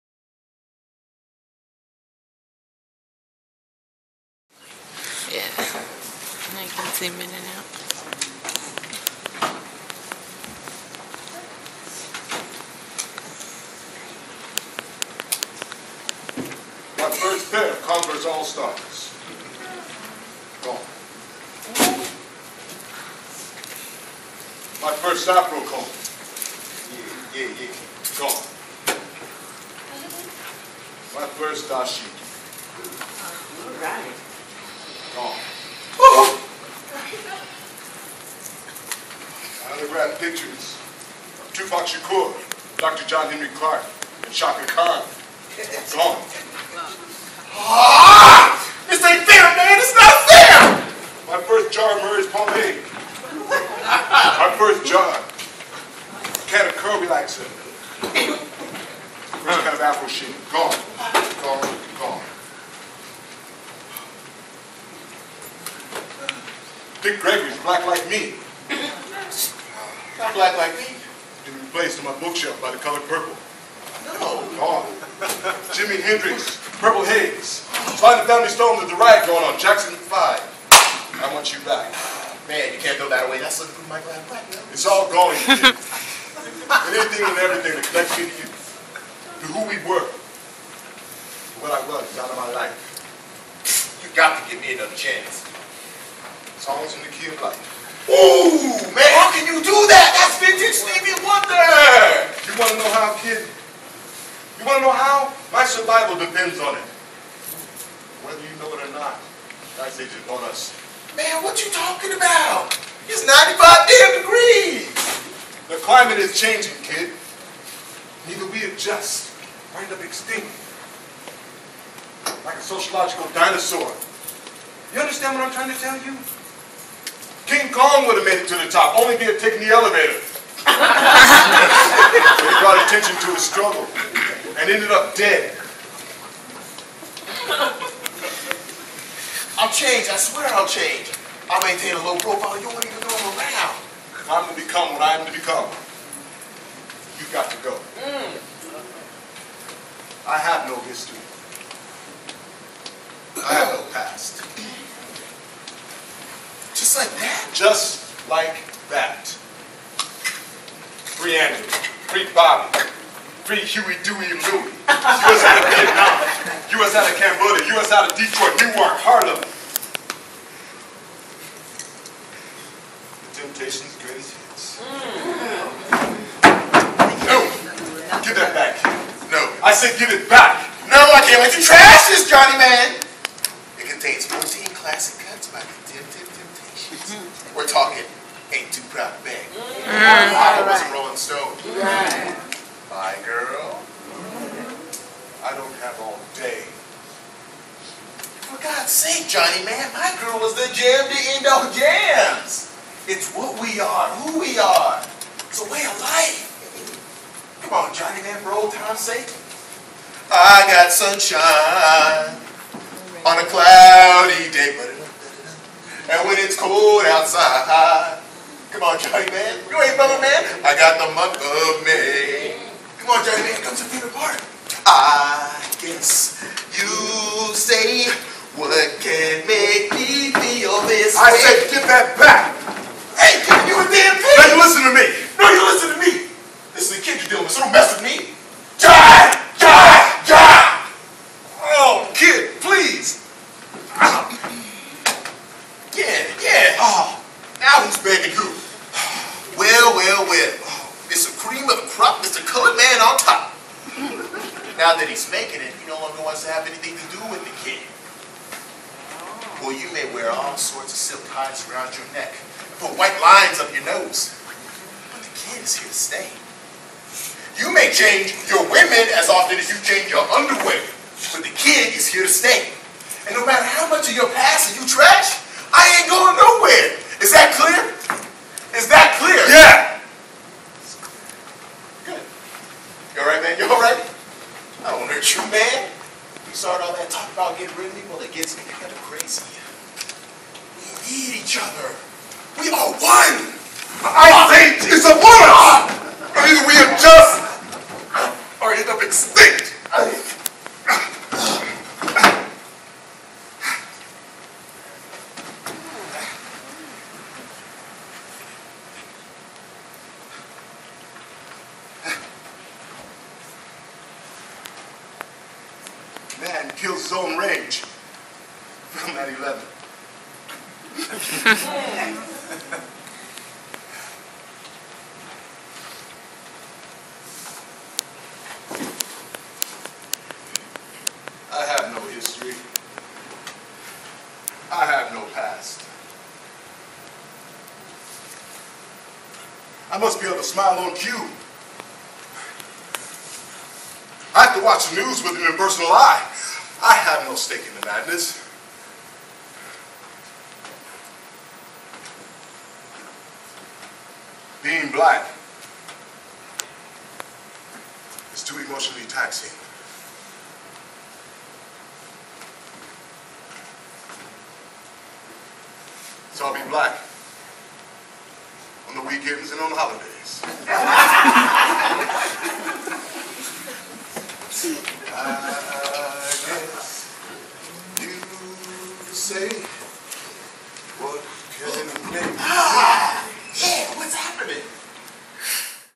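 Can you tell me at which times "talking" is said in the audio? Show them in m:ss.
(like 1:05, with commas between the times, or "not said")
1:51, 3:07.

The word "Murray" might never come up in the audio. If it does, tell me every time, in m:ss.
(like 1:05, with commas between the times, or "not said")
0:52.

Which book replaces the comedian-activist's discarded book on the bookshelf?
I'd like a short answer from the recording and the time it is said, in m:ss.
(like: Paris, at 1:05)
The Color Purple, at 1:12.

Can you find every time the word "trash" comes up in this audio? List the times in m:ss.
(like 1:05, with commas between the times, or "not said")
3:01, 4:34.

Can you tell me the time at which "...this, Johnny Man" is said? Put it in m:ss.
3:02.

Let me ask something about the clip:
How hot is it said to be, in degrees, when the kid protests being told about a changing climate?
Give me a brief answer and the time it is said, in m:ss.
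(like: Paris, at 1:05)
95, at 1:53.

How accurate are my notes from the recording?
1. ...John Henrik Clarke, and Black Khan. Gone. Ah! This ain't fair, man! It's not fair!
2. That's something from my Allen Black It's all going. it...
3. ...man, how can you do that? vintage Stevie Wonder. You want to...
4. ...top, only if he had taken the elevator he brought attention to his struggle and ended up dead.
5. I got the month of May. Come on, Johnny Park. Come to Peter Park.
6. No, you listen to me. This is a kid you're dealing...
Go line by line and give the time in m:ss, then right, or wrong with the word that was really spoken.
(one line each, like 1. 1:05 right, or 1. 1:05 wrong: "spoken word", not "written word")
1. 0:43 wrong: "Chaka", not "Black"
2. 1:23 right
3. 1:38 right
4. 2:08 right
5. 3:40 wrong: "Man", not "Park"
6. 3:55 right.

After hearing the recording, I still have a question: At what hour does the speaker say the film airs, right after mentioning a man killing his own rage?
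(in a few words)
11.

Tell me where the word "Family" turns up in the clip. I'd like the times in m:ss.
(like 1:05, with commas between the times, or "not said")
1:18.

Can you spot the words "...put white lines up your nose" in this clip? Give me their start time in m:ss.
4:22.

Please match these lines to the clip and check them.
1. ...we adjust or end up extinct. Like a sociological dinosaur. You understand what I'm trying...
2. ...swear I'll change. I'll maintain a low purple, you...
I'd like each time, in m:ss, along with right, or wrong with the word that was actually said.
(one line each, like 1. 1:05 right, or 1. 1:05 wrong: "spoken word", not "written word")
1. 1:58 right
2. 2:20 wrong: "profile", not "purple".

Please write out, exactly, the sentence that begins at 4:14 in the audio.
Now that he's making it, he no longer wants to have anything to do with the kid.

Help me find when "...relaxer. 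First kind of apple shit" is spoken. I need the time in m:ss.
0:57.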